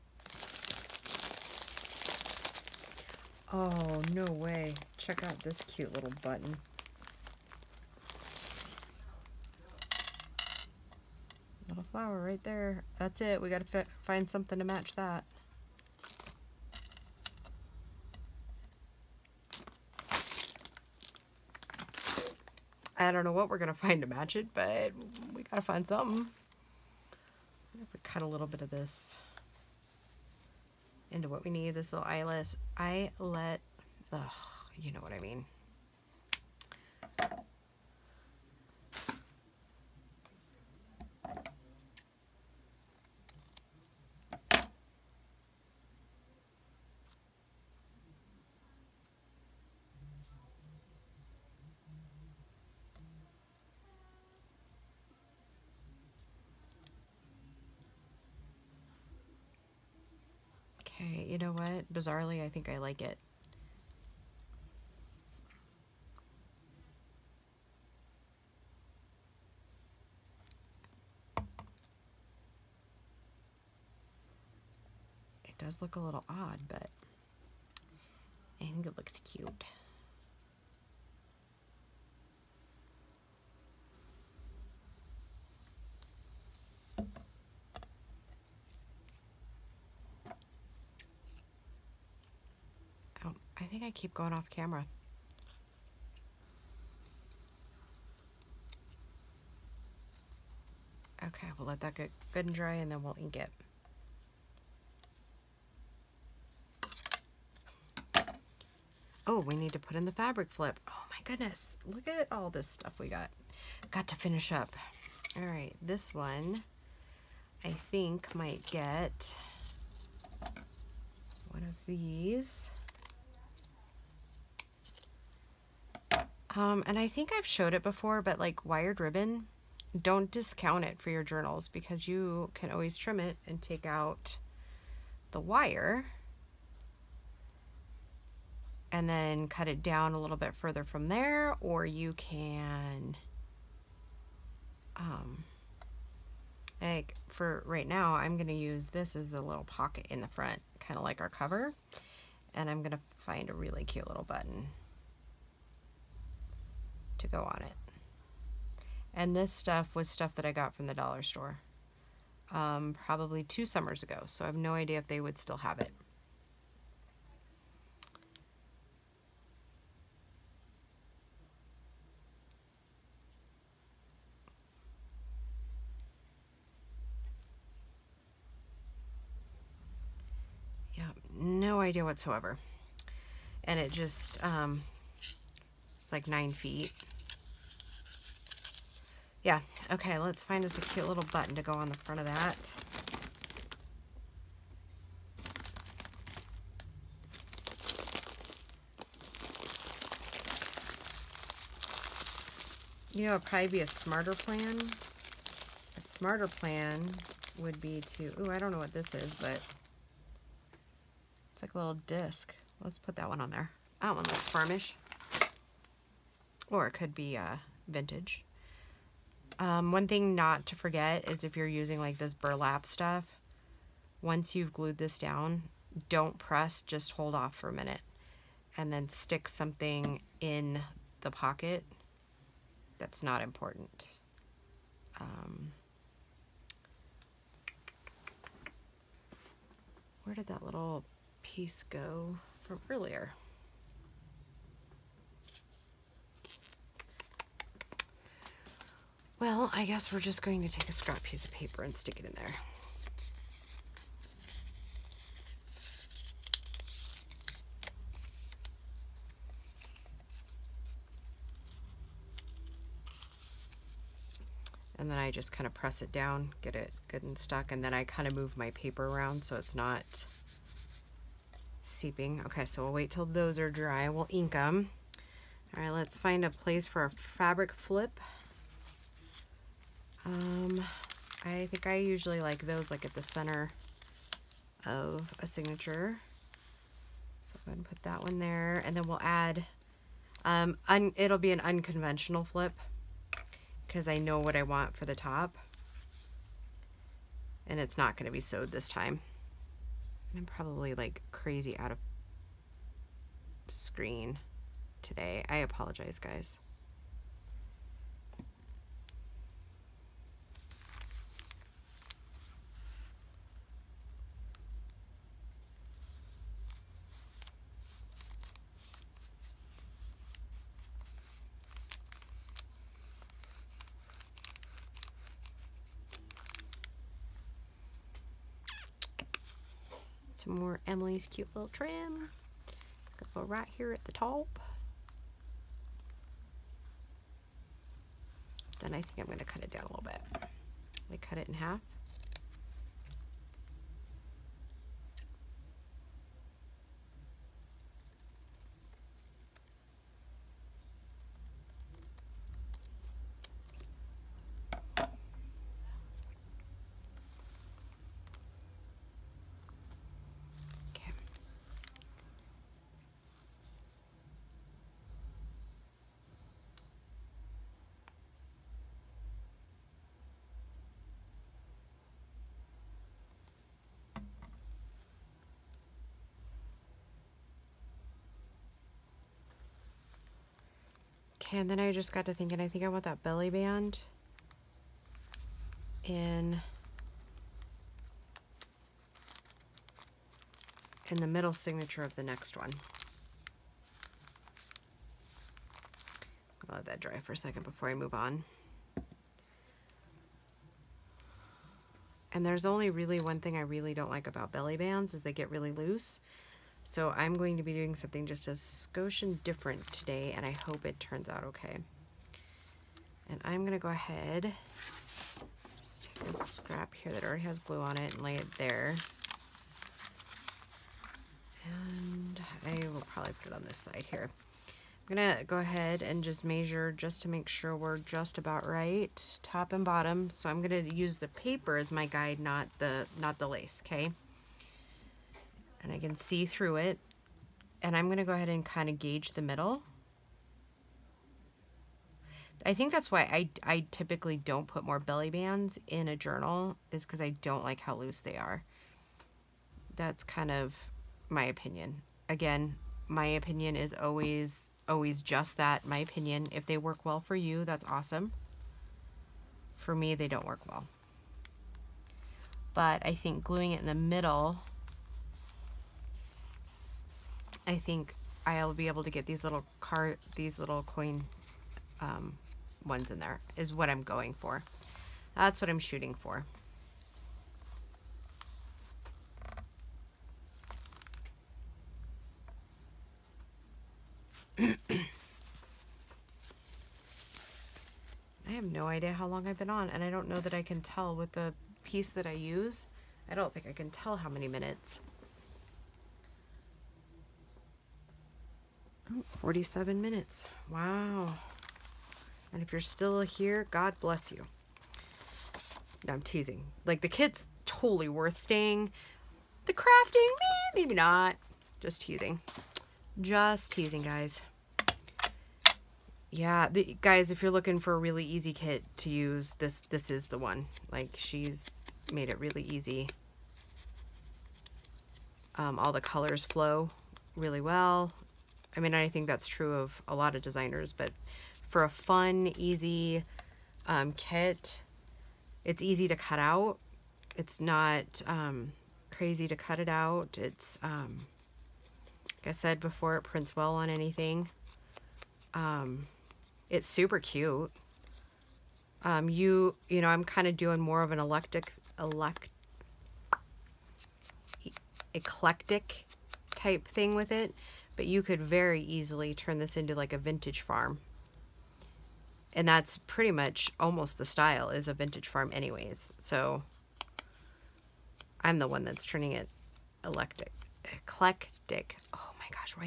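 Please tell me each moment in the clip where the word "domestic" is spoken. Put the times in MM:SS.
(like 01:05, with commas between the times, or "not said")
not said.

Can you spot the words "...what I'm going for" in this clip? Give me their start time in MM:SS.
07:53.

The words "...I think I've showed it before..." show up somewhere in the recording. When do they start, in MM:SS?
02:06.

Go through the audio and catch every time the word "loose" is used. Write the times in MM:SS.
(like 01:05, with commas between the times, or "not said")
06:45, 07:27.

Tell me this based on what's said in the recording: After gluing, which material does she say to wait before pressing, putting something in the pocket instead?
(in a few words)
burlap.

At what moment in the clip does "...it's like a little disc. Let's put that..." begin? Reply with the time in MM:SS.
03:31.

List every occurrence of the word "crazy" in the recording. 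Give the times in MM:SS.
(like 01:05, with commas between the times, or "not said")
05:01, 08:59.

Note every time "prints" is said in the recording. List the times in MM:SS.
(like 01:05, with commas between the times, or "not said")
09:03.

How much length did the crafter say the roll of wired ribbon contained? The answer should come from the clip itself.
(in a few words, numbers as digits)
9 feet.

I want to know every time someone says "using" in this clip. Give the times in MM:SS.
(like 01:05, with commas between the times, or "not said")
03:41.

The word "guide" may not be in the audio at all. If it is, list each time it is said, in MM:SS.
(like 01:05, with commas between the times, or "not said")
07:12.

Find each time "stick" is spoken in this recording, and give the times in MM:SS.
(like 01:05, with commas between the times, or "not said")
03:49, 04:11.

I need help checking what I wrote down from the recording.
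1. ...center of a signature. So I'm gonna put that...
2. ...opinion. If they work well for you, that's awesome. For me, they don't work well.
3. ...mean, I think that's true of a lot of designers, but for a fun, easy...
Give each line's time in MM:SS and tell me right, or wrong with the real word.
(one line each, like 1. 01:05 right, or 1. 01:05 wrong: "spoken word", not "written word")
1. 04:43 right
2. 07:35 right
3. 08:48 right.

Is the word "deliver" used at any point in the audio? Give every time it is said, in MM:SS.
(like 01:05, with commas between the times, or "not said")
not said.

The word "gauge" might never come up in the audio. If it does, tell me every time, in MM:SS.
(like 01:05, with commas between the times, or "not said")
07:18.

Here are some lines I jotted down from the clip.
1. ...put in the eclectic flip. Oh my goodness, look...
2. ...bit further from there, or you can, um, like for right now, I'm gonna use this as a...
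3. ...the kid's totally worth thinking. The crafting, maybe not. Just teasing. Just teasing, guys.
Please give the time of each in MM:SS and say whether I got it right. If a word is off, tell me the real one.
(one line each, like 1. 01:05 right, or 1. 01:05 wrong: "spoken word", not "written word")
1. 01:49 wrong: "fabric", not "eclectic"
2. 02:20 right
3. 08:27 wrong: "staying", not "thinking".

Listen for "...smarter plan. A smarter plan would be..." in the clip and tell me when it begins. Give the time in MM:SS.
03:23.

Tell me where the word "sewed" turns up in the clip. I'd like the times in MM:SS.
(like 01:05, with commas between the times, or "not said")
04:58.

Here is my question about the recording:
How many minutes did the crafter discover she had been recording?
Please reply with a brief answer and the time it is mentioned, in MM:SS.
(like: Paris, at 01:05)
47, at 08:19.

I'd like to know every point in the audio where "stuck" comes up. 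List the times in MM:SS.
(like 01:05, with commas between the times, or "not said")
04:27.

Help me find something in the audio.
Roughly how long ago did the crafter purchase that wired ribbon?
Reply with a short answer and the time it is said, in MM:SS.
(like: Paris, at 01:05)
two summers ago, at 02:43.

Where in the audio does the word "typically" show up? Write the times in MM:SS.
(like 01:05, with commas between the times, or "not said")
07:23.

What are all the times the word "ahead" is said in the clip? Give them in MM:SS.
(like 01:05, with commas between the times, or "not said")
06:53, 07:05, 07:18.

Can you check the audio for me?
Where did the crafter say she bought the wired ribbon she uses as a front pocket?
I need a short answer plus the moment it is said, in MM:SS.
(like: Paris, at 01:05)
the dollar store, at 02:40.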